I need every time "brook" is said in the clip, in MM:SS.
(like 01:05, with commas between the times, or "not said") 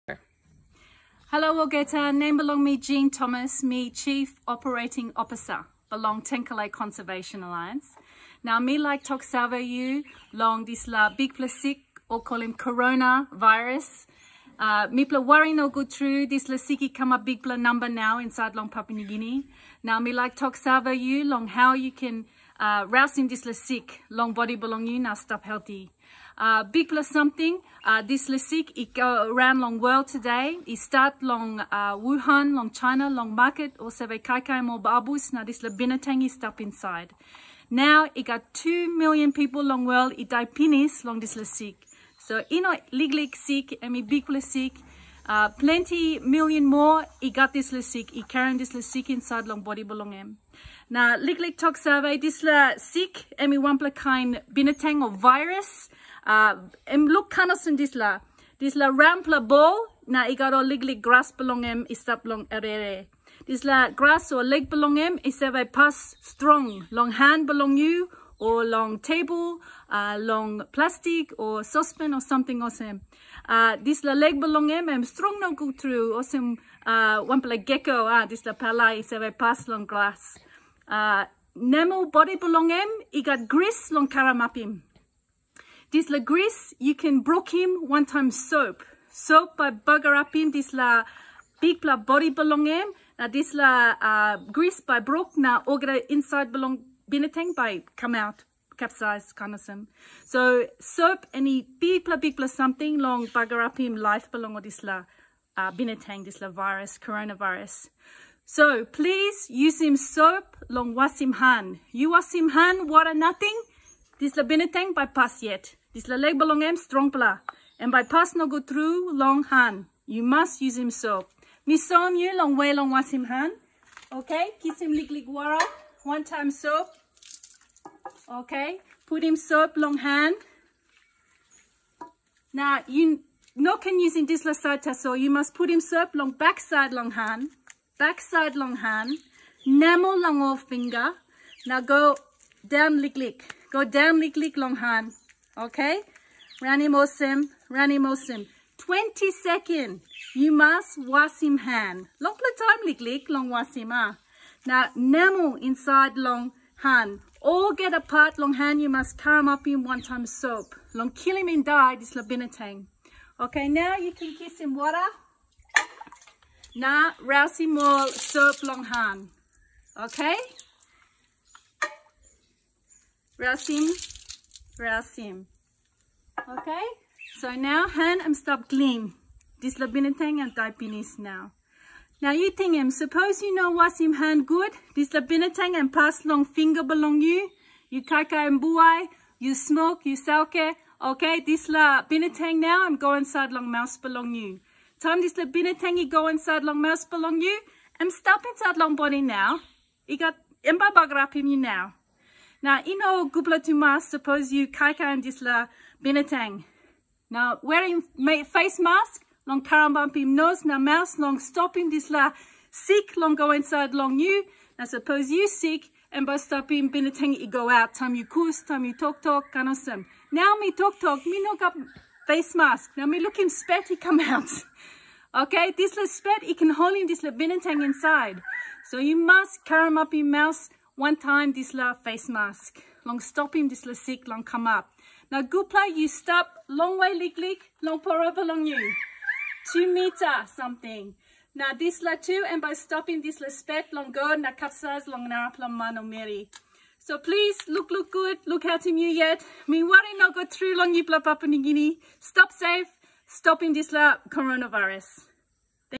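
01:27, 01:34.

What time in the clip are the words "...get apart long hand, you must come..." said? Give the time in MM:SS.
02:37.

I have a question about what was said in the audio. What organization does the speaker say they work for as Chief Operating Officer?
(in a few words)
Tenkile Conservation Alliance.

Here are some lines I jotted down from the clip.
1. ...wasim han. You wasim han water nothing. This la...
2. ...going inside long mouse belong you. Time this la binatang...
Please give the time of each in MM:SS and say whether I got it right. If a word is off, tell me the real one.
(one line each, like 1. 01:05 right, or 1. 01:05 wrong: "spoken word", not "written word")
1. 01:50 right
2. 03:12 right.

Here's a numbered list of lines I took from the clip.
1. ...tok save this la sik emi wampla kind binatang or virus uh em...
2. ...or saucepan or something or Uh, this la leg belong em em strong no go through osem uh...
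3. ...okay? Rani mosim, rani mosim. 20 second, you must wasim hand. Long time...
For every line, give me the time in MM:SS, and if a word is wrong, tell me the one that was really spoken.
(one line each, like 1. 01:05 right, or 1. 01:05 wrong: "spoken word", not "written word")
1. 00:51 right
2. 01:11 right
3. 02:25 right.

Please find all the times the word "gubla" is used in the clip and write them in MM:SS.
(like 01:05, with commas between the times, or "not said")
03:23.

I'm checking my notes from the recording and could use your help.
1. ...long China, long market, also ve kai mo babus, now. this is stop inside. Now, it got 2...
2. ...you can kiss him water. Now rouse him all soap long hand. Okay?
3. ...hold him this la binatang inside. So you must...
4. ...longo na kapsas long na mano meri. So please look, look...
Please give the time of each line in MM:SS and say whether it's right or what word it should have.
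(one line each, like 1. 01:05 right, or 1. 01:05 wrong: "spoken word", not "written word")
1. 00:32 right
2. 02:43 right
3. 03:46 right
4. 04:03 right.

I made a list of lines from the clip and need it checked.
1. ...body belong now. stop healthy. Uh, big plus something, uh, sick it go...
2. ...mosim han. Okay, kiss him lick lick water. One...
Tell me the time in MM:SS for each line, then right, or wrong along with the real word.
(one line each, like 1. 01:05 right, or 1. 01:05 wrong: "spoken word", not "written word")
1. 00:24 right
2. 02:02 wrong: "wasim", not "mosim".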